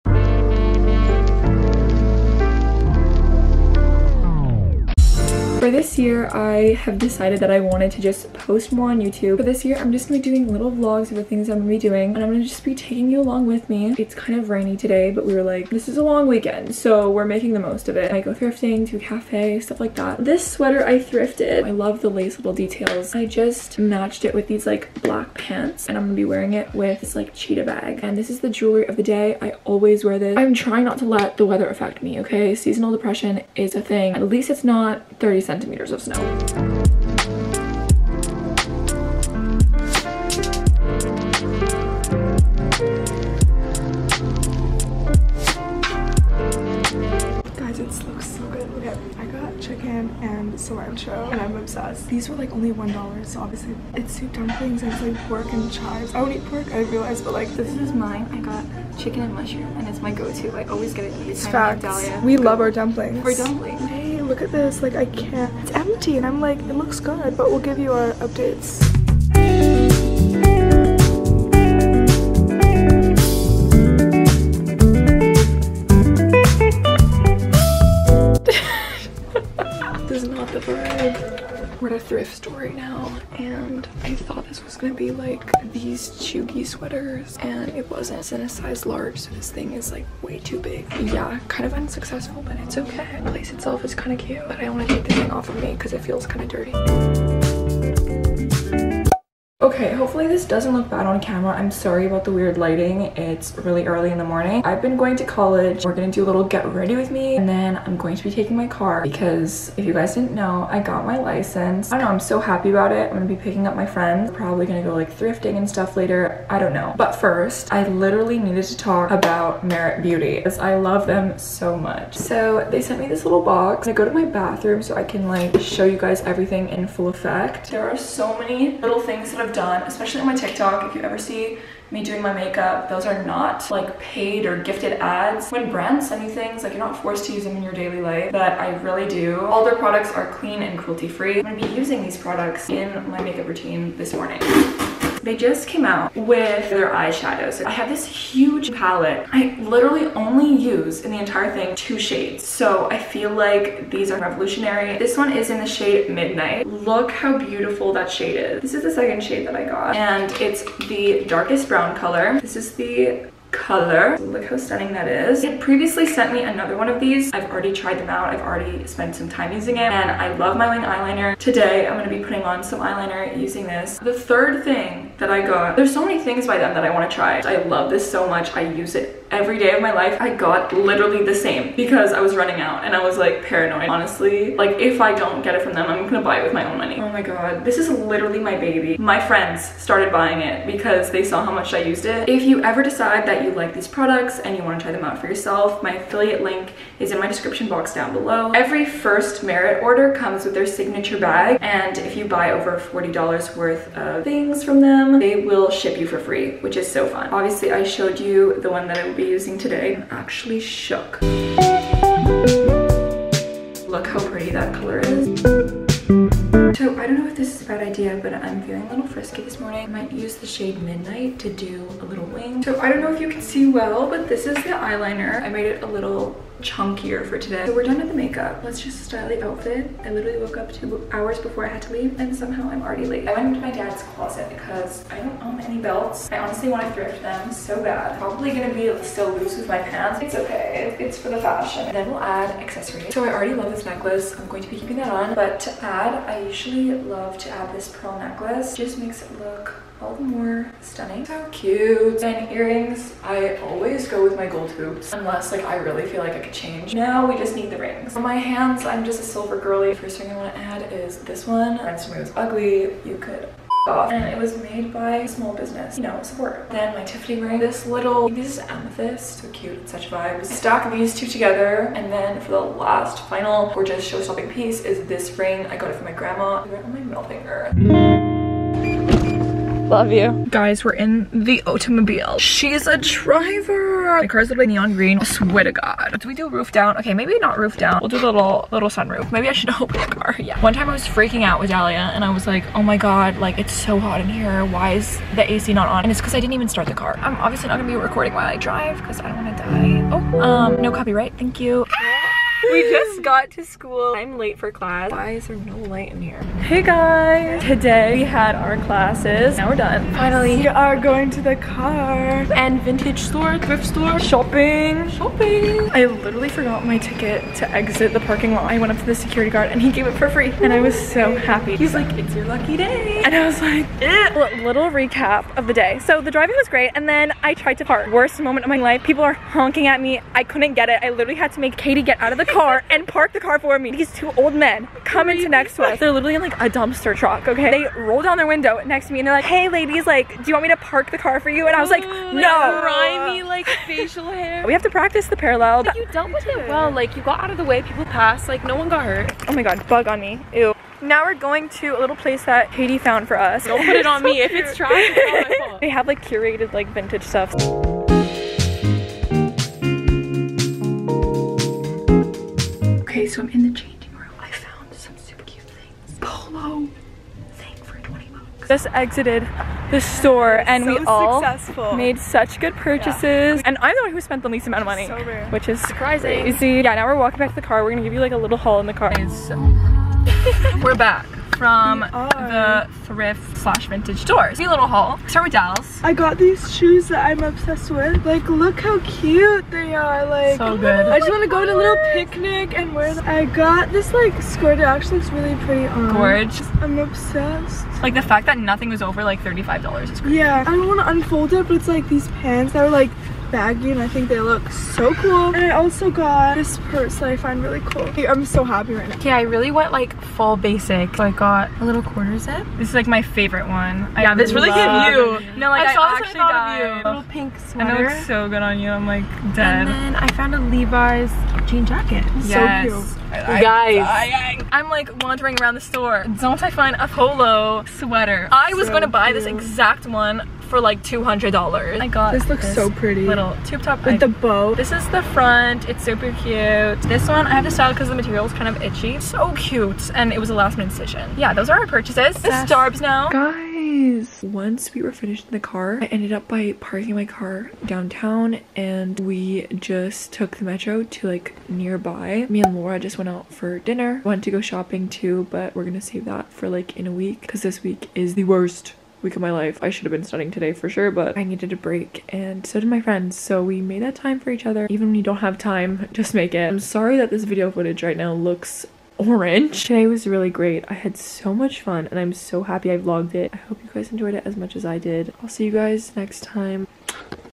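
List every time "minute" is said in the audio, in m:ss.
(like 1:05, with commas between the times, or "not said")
7:20.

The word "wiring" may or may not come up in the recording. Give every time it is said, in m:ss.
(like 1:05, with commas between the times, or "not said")
not said.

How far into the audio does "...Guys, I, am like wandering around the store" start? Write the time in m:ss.
7:03.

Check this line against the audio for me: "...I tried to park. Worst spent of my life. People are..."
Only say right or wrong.
wrong.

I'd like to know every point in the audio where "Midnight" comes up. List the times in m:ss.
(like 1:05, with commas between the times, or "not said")
2:36, 3:40.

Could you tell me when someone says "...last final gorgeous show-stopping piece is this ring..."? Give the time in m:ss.
4:32.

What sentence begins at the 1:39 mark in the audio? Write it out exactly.
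Okay, hopefully this doesn't look bad on camera.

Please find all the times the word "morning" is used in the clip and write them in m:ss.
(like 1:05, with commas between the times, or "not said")
1:44, 2:24, 3:39.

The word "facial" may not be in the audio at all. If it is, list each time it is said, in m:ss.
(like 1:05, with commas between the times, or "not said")
5:43.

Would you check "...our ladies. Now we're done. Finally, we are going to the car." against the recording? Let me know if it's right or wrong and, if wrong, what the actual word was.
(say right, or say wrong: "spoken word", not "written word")
wrong: "classes", not "ladies".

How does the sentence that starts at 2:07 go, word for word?
There are so many little things that I've done done, especially on my TikTok.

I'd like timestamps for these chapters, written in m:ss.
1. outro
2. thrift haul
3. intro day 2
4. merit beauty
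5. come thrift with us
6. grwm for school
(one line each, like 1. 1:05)
1. 7:23
2. 6:09
3. 1:39
4. 2:00
5. 5:05
6. 3:30.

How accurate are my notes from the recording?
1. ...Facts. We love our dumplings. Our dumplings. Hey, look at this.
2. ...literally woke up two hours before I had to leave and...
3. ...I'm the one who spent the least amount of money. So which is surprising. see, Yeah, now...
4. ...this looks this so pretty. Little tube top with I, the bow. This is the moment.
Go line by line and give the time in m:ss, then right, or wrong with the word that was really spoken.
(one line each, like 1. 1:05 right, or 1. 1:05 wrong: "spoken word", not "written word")
1. 1:01 right
2. 3:50 right
3. 6:13 right
4. 7:12 wrong: "front", not "moment".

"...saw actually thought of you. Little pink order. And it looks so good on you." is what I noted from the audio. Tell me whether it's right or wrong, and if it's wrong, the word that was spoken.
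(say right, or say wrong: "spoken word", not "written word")
wrong: "sweater", not "order".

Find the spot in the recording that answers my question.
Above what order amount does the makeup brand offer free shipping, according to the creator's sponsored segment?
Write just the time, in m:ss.
3:22.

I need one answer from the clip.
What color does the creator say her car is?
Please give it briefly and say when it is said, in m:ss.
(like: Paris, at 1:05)
Neon green, at 4:44.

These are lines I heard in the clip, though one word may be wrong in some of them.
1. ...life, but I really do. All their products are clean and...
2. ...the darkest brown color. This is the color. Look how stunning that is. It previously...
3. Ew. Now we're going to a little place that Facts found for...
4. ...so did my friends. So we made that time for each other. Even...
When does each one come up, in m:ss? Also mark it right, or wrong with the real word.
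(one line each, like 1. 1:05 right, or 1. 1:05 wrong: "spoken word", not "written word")
1. 2:18 right
2. 2:40 right
3. 5:50 wrong: "Katie", not "Facts"
4. 7:42 right.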